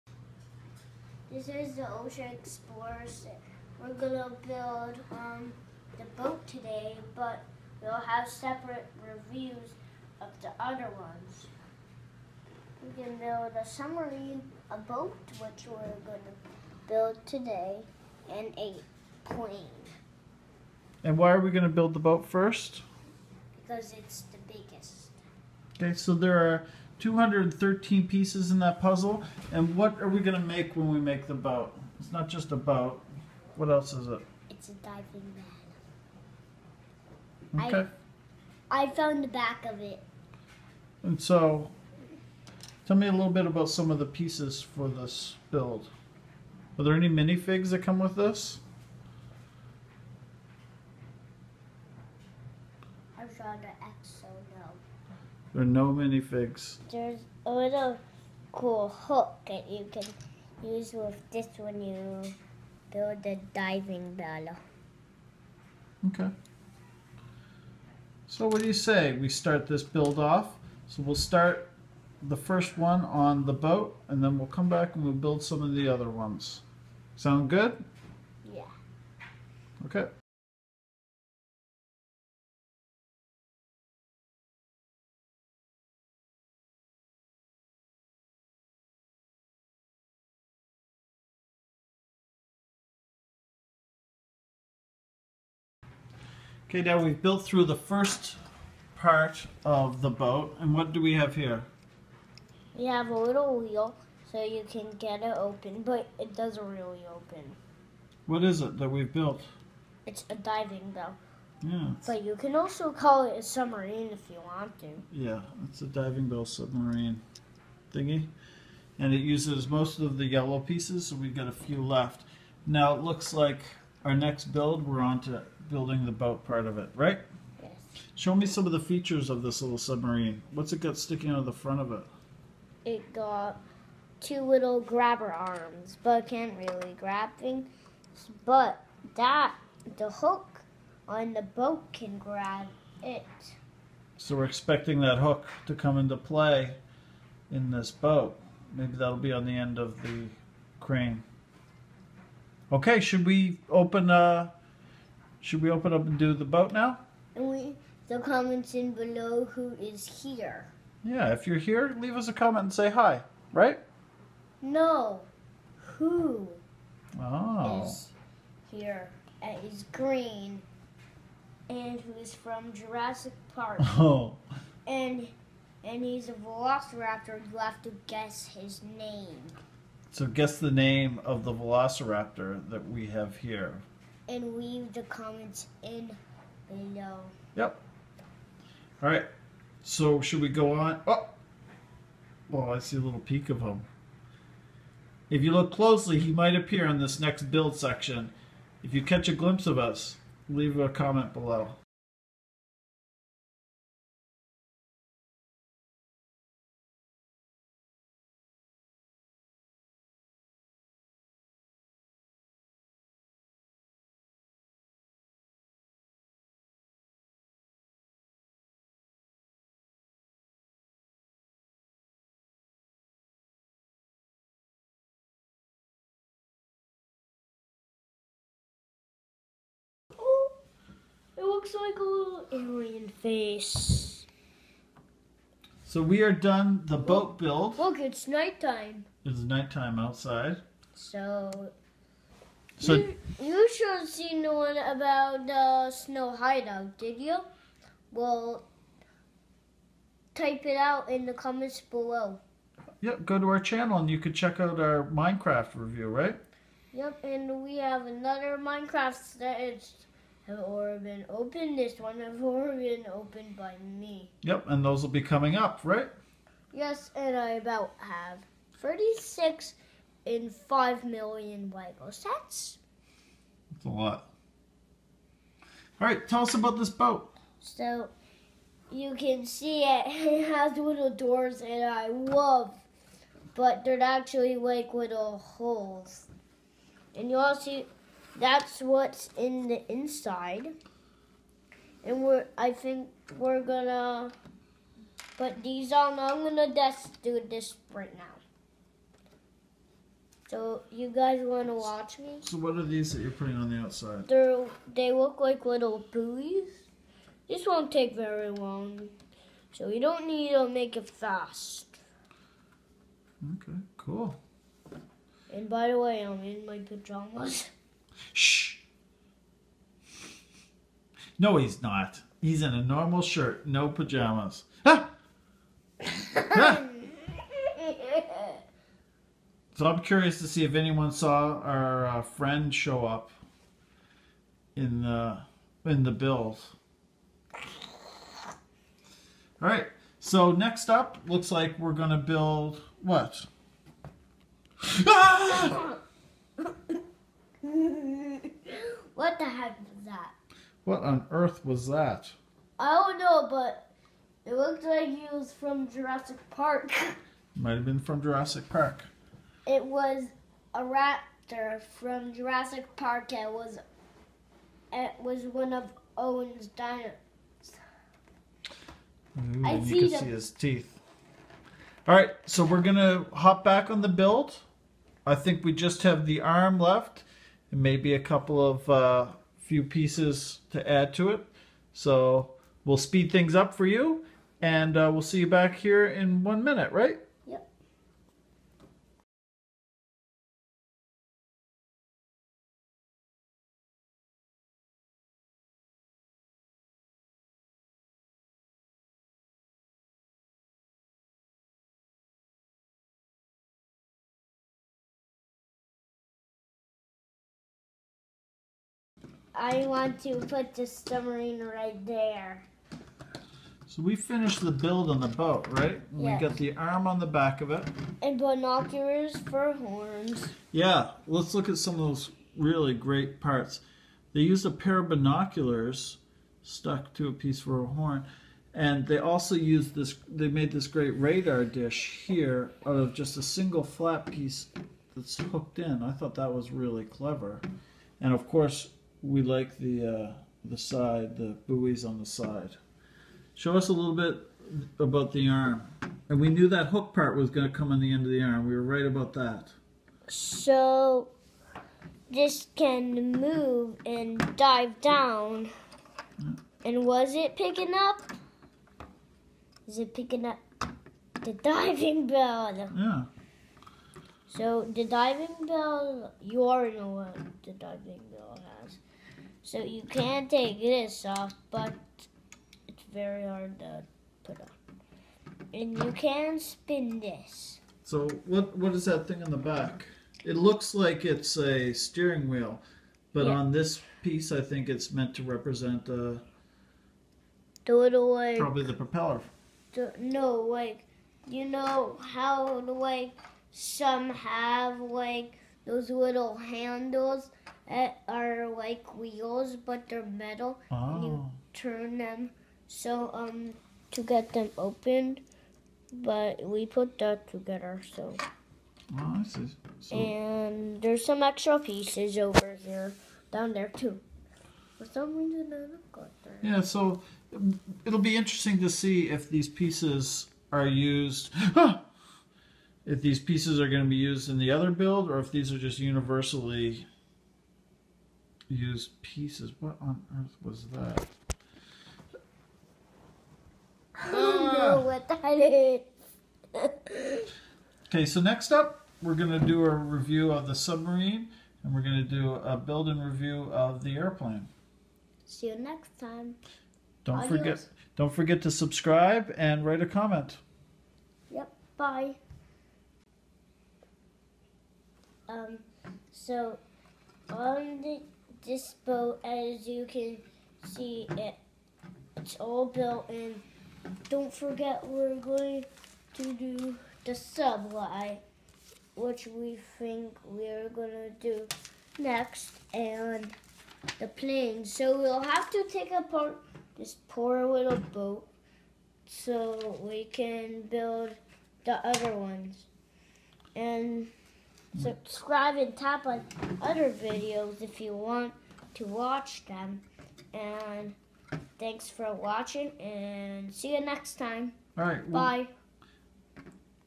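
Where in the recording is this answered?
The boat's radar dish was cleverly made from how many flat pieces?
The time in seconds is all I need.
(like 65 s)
433 s.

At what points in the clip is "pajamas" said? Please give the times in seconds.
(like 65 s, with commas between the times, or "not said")
316 s, 323 s.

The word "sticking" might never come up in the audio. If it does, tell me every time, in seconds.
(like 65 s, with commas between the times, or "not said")
130 s.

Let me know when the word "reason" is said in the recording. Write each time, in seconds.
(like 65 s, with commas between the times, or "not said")
515 s.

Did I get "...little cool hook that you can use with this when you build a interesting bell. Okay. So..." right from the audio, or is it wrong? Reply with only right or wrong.
wrong.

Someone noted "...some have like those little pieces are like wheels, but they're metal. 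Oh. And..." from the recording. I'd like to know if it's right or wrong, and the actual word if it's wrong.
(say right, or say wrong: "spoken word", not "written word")
wrong: "handles", not "pieces".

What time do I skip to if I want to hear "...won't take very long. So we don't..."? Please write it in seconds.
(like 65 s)
307 s.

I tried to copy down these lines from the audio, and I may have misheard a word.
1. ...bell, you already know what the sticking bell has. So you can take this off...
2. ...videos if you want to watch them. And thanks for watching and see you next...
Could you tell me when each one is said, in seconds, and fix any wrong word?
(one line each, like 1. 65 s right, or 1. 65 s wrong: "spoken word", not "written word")
1. 465 s wrong: "diving", not "sticking"
2. 587 s right.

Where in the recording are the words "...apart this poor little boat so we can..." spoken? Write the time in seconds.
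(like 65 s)
576 s.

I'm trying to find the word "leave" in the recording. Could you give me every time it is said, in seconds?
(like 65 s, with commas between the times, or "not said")
161 s, 184 s, 200 s.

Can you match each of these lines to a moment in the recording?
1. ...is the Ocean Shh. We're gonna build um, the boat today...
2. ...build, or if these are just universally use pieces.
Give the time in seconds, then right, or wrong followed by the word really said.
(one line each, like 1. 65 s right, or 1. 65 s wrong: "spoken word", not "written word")
1. 1 s wrong: "Explorers", not "Shh"
2. 524 s right.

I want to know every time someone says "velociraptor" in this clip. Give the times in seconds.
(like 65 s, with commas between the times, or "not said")
176 s, 181 s.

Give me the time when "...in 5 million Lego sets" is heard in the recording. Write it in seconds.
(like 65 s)
270 s.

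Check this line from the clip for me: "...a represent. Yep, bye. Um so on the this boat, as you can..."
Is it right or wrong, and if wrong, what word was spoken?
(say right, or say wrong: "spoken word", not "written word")
wrong: "comment", not "represent".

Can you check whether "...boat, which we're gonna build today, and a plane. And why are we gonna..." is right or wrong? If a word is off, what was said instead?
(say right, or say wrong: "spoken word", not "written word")
right.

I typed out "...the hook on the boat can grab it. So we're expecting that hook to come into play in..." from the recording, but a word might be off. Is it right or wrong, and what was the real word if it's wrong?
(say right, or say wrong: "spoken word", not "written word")
right.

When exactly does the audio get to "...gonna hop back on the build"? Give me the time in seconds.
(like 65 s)
372 s.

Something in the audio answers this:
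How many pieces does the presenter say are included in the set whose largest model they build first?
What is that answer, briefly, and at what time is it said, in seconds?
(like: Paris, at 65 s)
213, at 27 s.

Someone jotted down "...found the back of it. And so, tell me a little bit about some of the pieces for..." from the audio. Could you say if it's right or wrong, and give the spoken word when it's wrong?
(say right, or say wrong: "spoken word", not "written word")
right.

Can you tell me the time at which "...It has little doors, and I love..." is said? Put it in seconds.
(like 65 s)
280 s.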